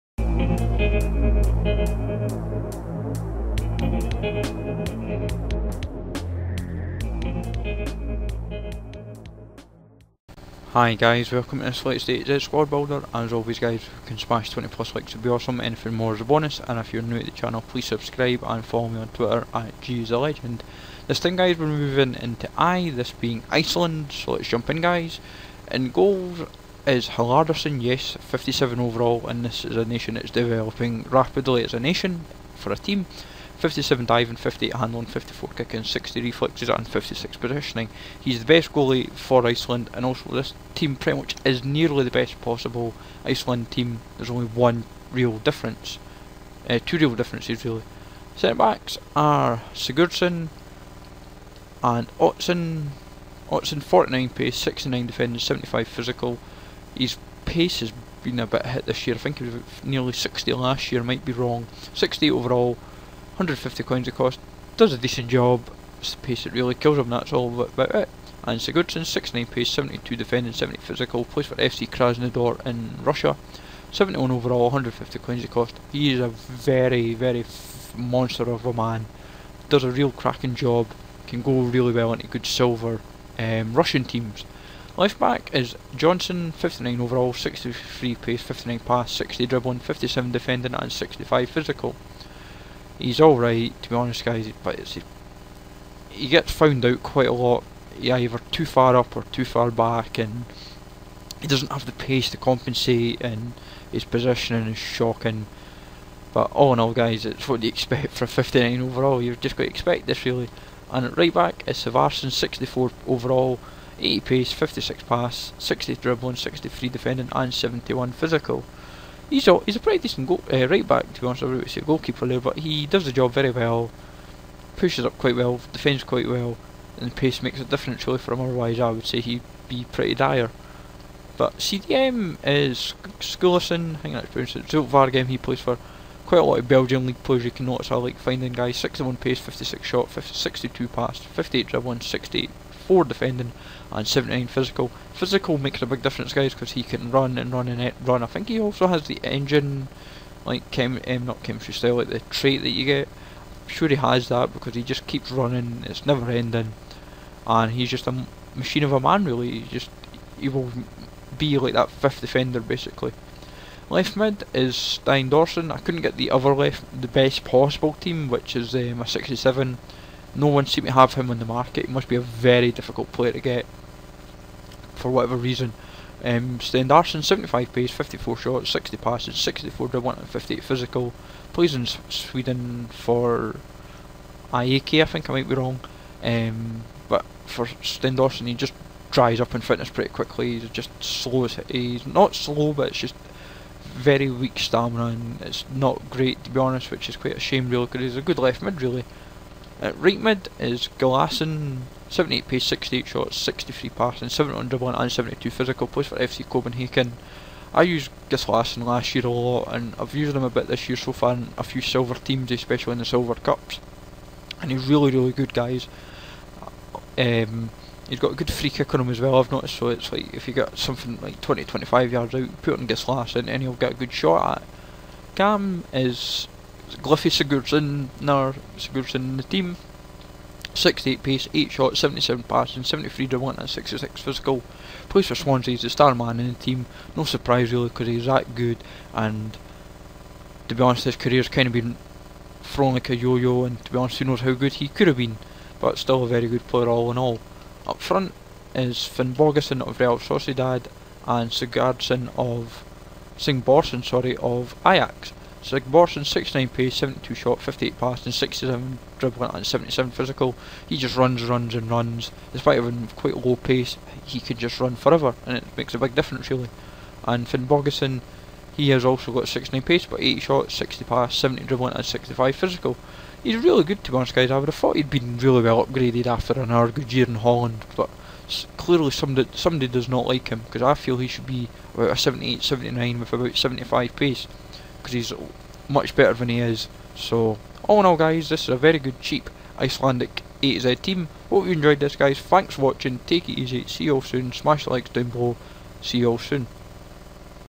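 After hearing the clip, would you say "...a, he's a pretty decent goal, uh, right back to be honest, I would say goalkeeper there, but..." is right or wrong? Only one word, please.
right.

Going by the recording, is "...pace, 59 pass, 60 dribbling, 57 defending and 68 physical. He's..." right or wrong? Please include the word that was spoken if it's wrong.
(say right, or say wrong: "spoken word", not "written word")
wrong: "65", not "68".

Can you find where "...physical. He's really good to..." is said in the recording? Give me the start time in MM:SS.
04:32.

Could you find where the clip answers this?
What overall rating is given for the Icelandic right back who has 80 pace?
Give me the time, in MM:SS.
01:52.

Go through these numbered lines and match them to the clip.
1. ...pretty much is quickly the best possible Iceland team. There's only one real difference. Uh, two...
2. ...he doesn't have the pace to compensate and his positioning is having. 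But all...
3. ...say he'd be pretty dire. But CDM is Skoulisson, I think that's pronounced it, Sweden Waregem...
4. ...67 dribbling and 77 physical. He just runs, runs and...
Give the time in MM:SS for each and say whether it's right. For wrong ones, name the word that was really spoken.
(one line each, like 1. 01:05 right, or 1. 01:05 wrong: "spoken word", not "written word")
1. 00:40 wrong: "nearly", not "quickly"
2. 01:41 wrong: "shocking", not "having"
3. 02:09 wrong: "Zulte", not "Sweden"
4. 04:18 right.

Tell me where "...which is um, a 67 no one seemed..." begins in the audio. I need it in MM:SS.
02:48.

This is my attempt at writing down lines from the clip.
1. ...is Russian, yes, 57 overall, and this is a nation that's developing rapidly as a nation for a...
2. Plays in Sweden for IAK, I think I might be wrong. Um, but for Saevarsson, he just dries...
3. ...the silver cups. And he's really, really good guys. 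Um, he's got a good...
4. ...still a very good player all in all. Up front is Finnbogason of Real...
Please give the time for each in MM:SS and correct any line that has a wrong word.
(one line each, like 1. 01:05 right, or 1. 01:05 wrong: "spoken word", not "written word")
1. 00:26 wrong: "Halldorsson", not "Russian"
2. 03:01 wrong: "Darsen", not "Saevarsson"
3. 03:32 right
4. 04:05 right.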